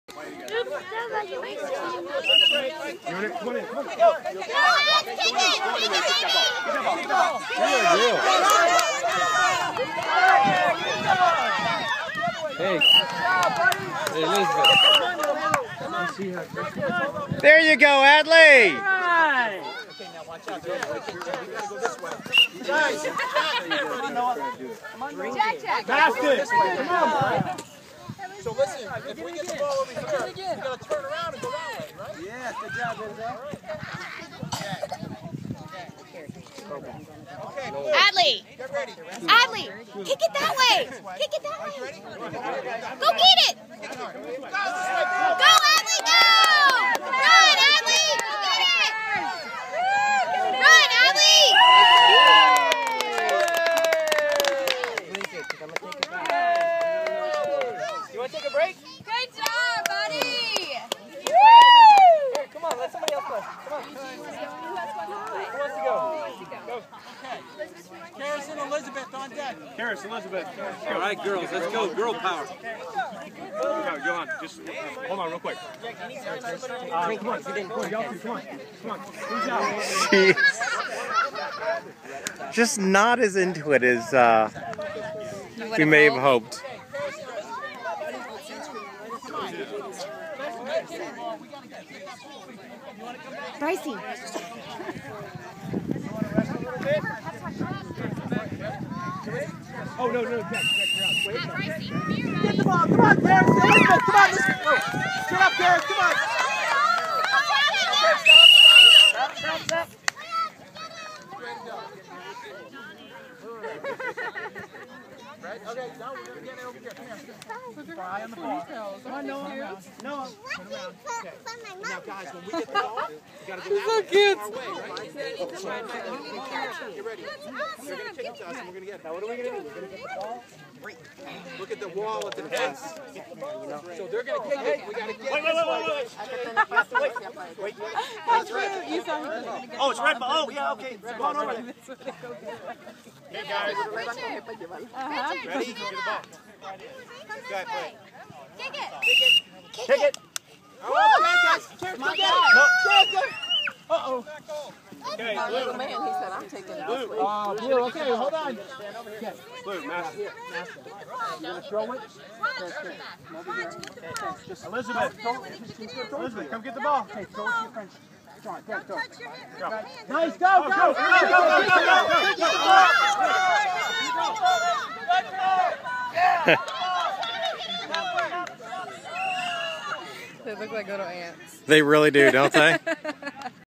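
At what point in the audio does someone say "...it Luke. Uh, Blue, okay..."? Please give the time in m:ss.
2:36.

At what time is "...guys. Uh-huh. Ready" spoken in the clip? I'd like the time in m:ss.
2:23.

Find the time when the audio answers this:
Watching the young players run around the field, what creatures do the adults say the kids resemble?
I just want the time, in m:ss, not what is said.
3:00.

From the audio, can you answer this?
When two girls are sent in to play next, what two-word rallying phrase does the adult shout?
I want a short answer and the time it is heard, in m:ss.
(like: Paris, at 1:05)
Girl power, at 1:11.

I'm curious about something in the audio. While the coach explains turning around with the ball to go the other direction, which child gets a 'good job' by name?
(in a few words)
Enzo.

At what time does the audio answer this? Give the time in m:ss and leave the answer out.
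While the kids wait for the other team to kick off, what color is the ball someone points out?
2:19.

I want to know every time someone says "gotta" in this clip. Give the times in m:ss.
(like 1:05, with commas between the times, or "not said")
0:30, 2:03.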